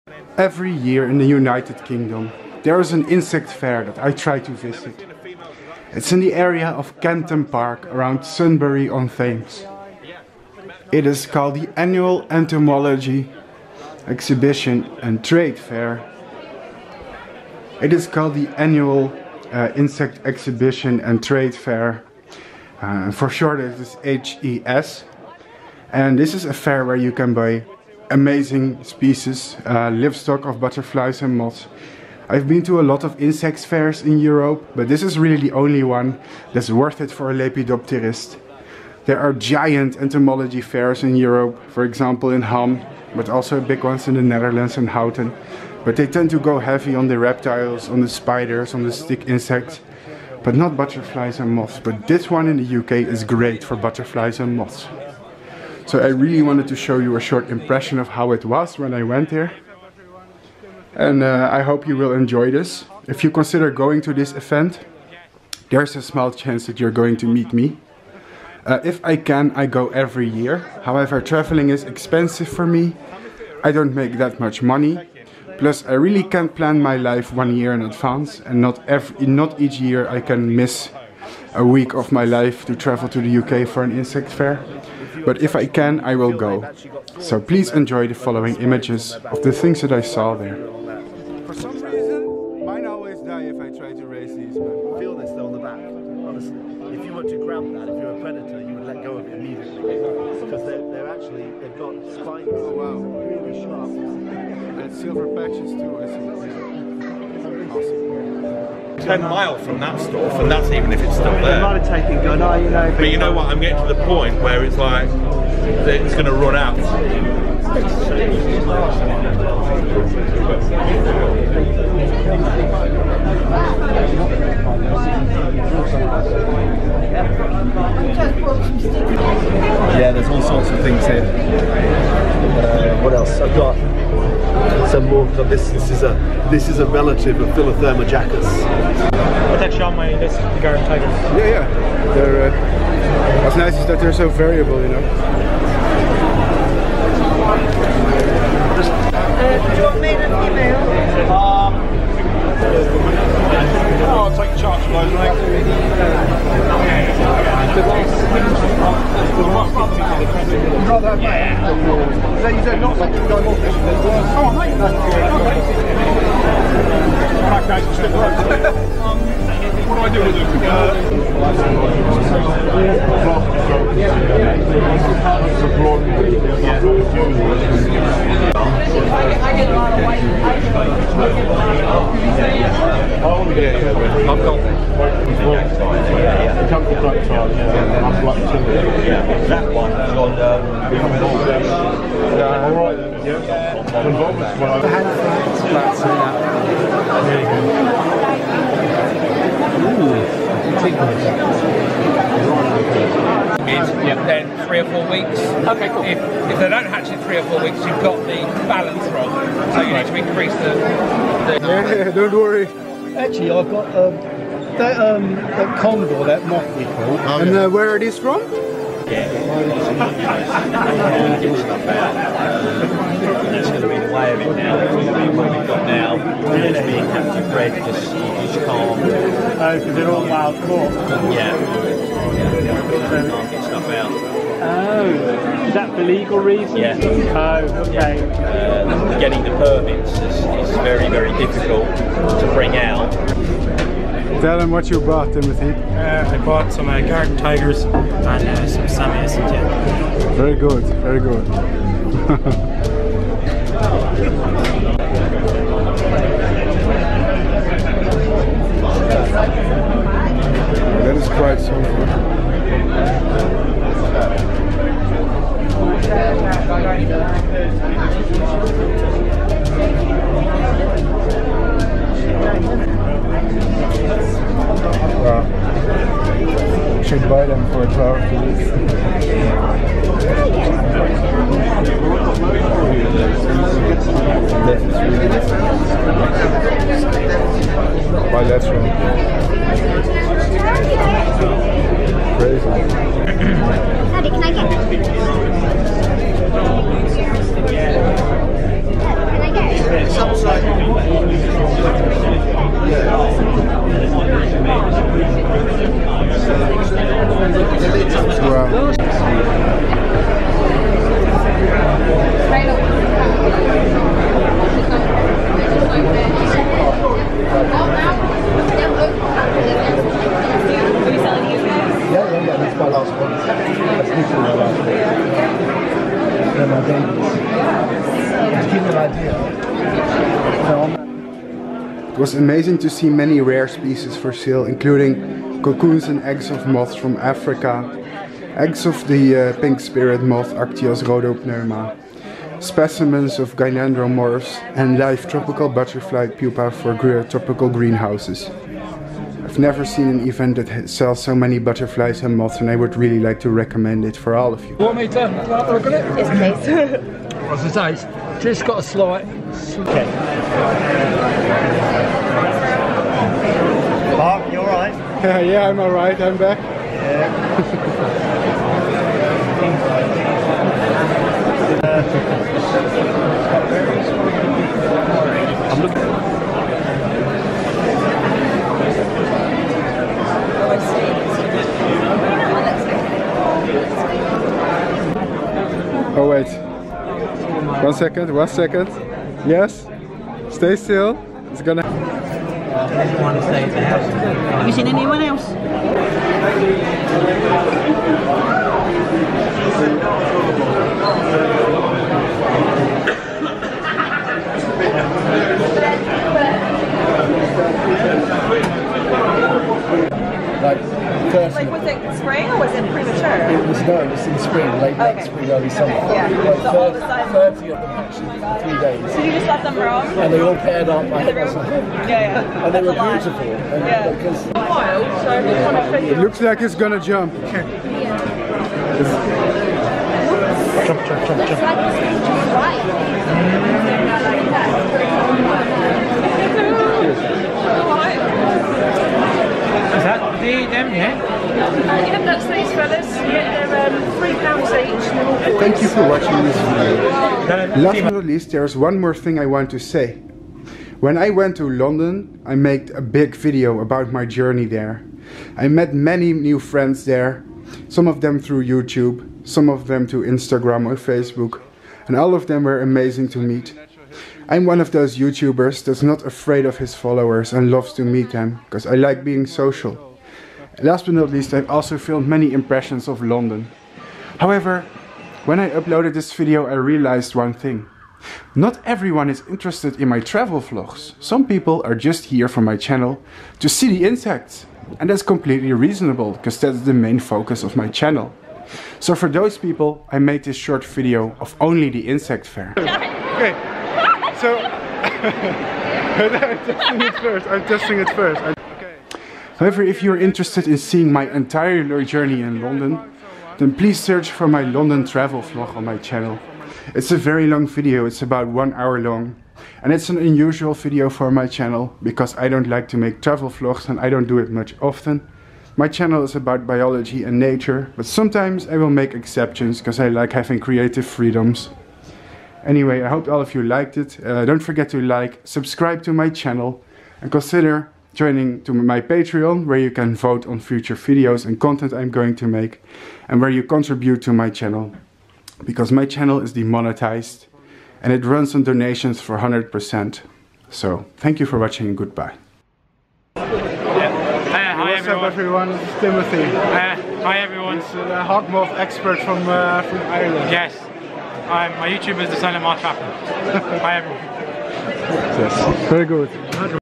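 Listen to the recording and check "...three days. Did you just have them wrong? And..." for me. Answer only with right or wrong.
right.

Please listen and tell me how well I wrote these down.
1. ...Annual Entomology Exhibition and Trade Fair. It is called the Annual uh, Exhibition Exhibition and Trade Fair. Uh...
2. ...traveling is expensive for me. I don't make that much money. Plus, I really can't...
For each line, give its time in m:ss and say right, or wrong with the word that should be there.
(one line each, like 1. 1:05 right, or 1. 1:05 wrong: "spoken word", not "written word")
1. 0:11 wrong: "Insect", not "Exhibition"
2. 1:11 right.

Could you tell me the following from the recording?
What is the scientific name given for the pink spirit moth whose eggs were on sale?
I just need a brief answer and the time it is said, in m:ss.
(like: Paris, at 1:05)
Actias rhodopneuma, at 5:40.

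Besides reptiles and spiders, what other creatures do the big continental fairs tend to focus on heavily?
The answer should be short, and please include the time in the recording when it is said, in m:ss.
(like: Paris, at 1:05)
stick insects, at 0:48.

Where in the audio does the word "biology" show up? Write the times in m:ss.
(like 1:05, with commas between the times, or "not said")
8:36.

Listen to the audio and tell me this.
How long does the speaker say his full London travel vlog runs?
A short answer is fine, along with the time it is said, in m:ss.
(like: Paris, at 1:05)
1 hour, at 8:28.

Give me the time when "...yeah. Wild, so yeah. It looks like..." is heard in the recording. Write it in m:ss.
7:03.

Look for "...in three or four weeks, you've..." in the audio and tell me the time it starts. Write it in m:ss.
3:27.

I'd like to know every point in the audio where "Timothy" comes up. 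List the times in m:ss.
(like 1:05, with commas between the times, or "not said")
4:05, 9:05.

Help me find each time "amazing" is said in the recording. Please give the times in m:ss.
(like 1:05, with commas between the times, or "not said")
0:28, 5:32, 7:42.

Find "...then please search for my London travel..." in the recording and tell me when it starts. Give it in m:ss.
8:23.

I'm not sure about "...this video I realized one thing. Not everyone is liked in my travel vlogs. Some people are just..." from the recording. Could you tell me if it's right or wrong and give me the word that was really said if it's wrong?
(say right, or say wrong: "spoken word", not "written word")
wrong: "interested", not "liked".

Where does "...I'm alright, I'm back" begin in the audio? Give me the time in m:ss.
6:05.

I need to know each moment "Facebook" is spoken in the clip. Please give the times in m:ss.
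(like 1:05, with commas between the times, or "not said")
7:40.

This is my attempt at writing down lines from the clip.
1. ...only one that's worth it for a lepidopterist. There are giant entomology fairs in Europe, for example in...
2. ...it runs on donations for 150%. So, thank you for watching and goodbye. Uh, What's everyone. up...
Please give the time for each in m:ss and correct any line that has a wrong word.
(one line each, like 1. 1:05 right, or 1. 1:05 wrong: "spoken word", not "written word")
1. 0:35 right
2. 8:58 wrong: "100", not "150".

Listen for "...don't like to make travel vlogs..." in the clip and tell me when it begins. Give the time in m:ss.
8:32.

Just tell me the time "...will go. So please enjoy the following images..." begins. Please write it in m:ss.
1:26.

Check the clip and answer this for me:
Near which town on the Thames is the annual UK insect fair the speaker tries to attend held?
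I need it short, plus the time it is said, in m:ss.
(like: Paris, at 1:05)
Sunbury on Thames, at 0:08.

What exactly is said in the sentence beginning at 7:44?
I'm one of those YouTubers that's not afraid of his followers and loves to meet them, because I like being social.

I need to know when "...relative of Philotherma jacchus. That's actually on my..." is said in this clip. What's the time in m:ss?
2:16.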